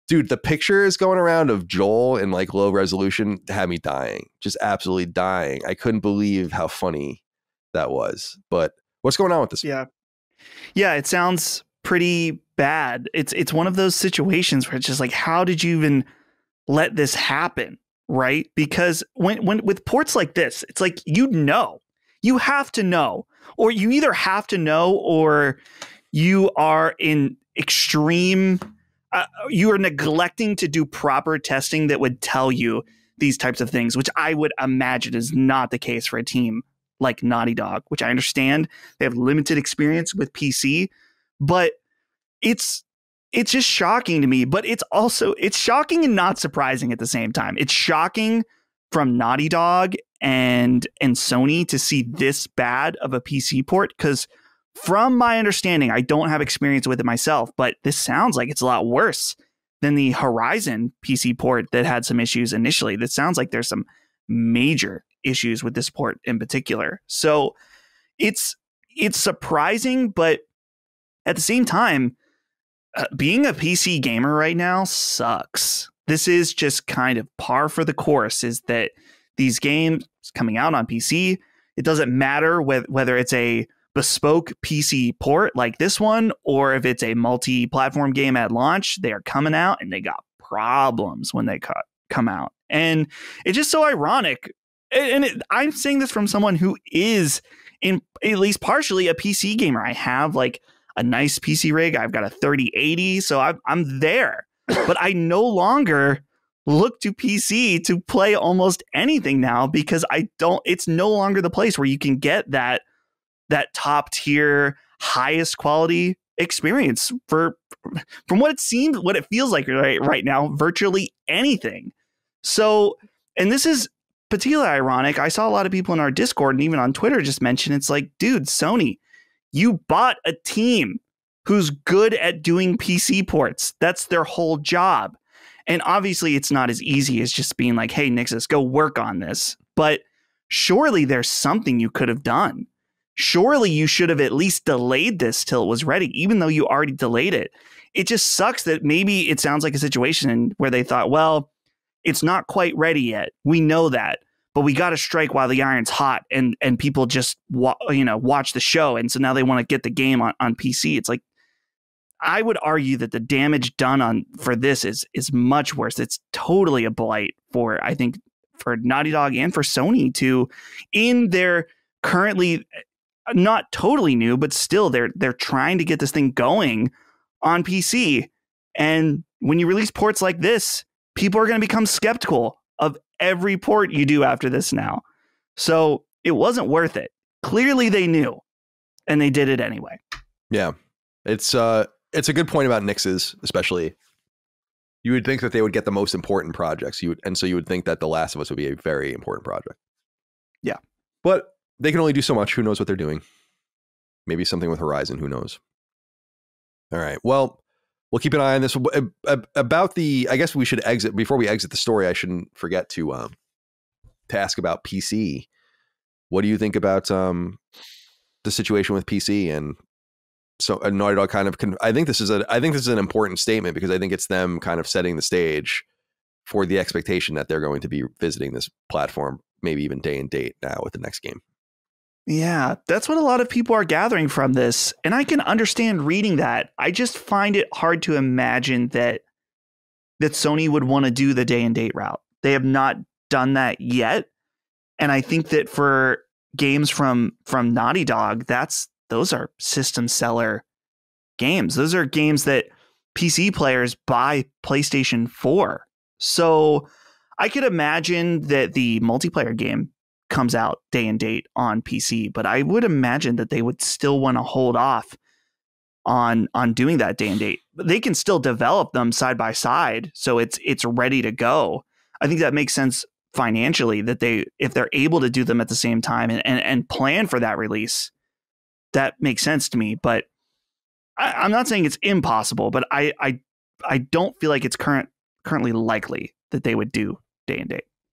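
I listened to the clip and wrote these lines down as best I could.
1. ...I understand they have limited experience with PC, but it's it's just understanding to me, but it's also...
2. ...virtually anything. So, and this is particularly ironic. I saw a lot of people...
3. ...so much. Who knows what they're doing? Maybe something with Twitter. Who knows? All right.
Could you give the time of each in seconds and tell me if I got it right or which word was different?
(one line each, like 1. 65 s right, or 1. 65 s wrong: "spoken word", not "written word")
1. 38 s wrong: "shocking", not "understanding"
2. 120 s right
3. 202 s wrong: "Horizon", not "Twitter".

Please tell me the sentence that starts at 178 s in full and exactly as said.
And when you release ports like this, people are going to become skeptical of every port you do after this now.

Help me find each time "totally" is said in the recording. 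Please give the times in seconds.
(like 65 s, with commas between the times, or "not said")
166 s, 173 s.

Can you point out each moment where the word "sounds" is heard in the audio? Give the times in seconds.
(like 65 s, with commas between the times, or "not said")
11 s, 57 s, 63 s, 149 s.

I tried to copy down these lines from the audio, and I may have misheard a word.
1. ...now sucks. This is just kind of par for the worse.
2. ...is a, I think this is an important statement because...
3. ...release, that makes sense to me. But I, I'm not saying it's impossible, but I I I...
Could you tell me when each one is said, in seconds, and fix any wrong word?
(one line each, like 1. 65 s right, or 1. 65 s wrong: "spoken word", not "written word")
1. 74 s wrong: "course", not "worse"
2. 222 s right
3. 277 s right.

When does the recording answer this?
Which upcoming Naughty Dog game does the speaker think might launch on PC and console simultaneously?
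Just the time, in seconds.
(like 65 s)
258 s.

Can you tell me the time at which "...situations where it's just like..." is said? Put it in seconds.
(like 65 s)
13 s.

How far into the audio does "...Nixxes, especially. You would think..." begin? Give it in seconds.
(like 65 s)
192 s.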